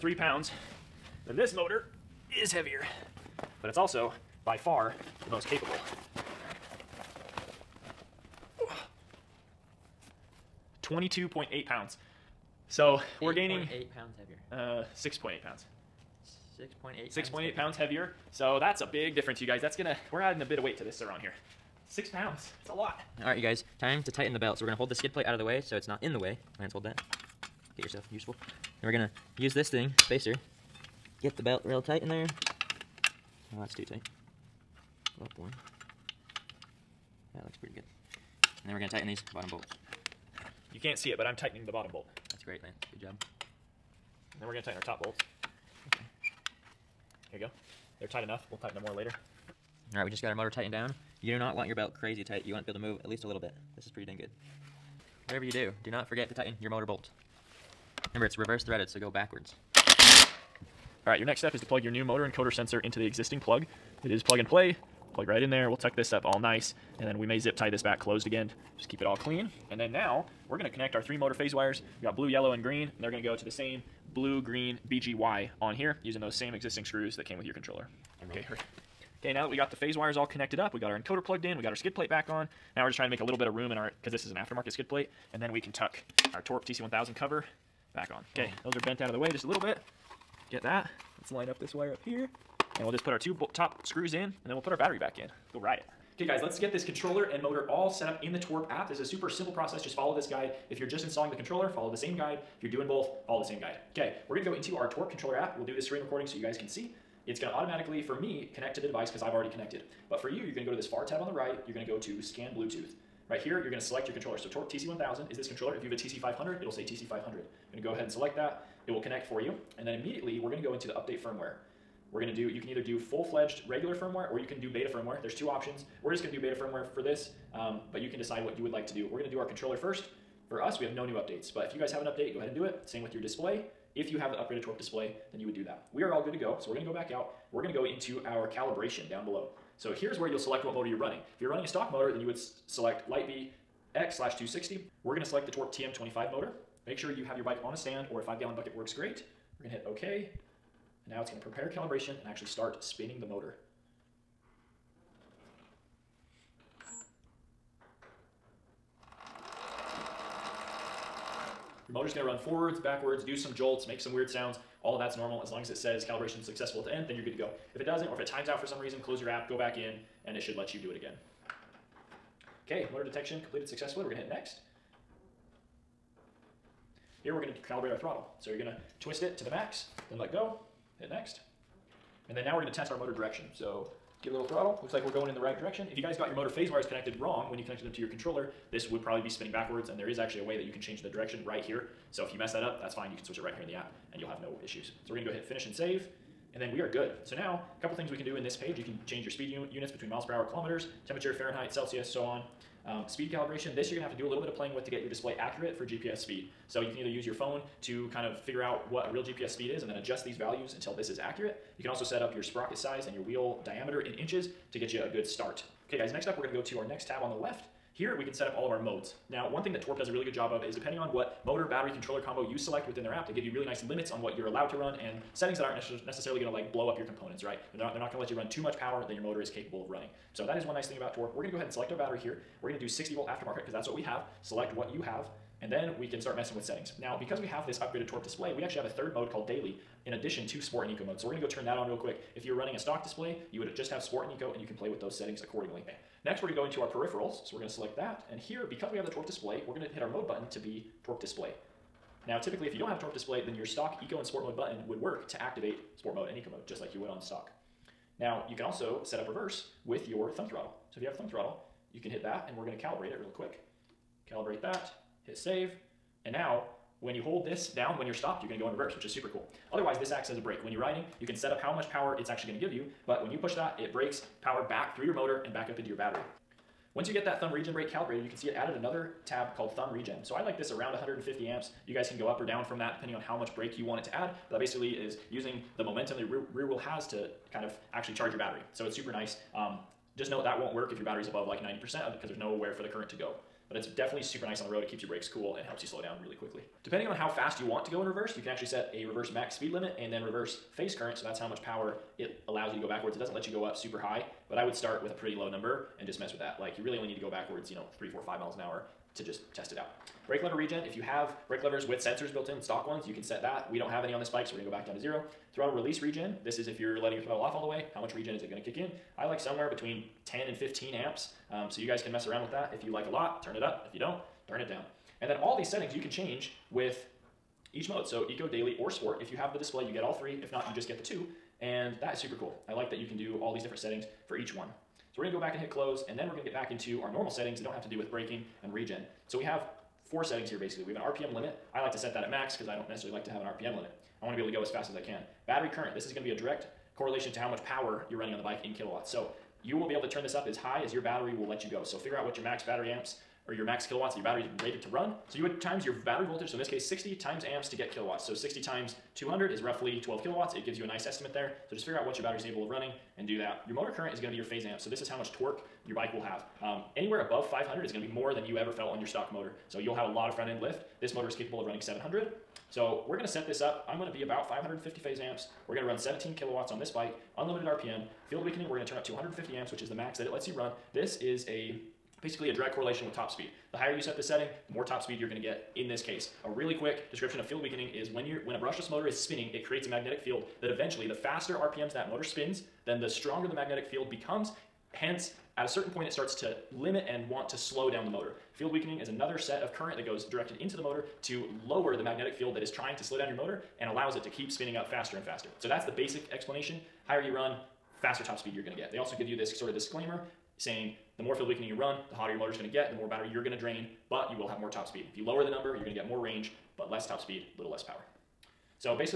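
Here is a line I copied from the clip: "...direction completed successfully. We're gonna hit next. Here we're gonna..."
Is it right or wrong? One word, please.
wrong.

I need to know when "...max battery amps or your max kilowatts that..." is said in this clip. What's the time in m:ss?
5:52.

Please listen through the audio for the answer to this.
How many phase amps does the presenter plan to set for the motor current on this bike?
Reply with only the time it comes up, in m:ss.
6:14.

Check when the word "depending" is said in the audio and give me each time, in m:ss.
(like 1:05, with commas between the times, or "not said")
3:40, 4:42, 4:56.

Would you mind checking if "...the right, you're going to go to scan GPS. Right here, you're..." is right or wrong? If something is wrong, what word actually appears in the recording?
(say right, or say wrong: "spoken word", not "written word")
wrong: "Bluetooth", not "GPS".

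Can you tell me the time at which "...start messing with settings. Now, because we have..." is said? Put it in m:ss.
3:56.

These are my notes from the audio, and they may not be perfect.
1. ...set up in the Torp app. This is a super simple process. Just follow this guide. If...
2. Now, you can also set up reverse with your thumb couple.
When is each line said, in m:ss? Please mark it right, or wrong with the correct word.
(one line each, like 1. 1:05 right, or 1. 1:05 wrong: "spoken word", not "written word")
1. 1:37 right
2. 4:18 wrong: "throttle", not "couple".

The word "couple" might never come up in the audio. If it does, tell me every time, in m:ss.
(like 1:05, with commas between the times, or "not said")
3:17.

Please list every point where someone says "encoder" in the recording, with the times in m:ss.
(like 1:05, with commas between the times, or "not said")
1:02, 1:20.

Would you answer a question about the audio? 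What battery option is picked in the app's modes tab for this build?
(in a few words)
60 volt aftermarket.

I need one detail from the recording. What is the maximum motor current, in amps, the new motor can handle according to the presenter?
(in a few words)
700.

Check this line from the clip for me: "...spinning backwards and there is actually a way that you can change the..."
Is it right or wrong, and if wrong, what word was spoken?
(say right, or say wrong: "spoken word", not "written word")
right.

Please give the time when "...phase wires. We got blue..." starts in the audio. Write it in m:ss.
1:11.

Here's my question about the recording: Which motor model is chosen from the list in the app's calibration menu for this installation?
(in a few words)
Torp TM25.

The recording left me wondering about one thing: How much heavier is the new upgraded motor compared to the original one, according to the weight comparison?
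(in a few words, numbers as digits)
6.8 pounds.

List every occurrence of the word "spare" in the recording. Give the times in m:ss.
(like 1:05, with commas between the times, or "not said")
not said.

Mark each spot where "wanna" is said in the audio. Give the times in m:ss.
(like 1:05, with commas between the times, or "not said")
not said.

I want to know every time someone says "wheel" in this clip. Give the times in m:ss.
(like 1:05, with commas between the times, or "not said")
3:33, 4:46.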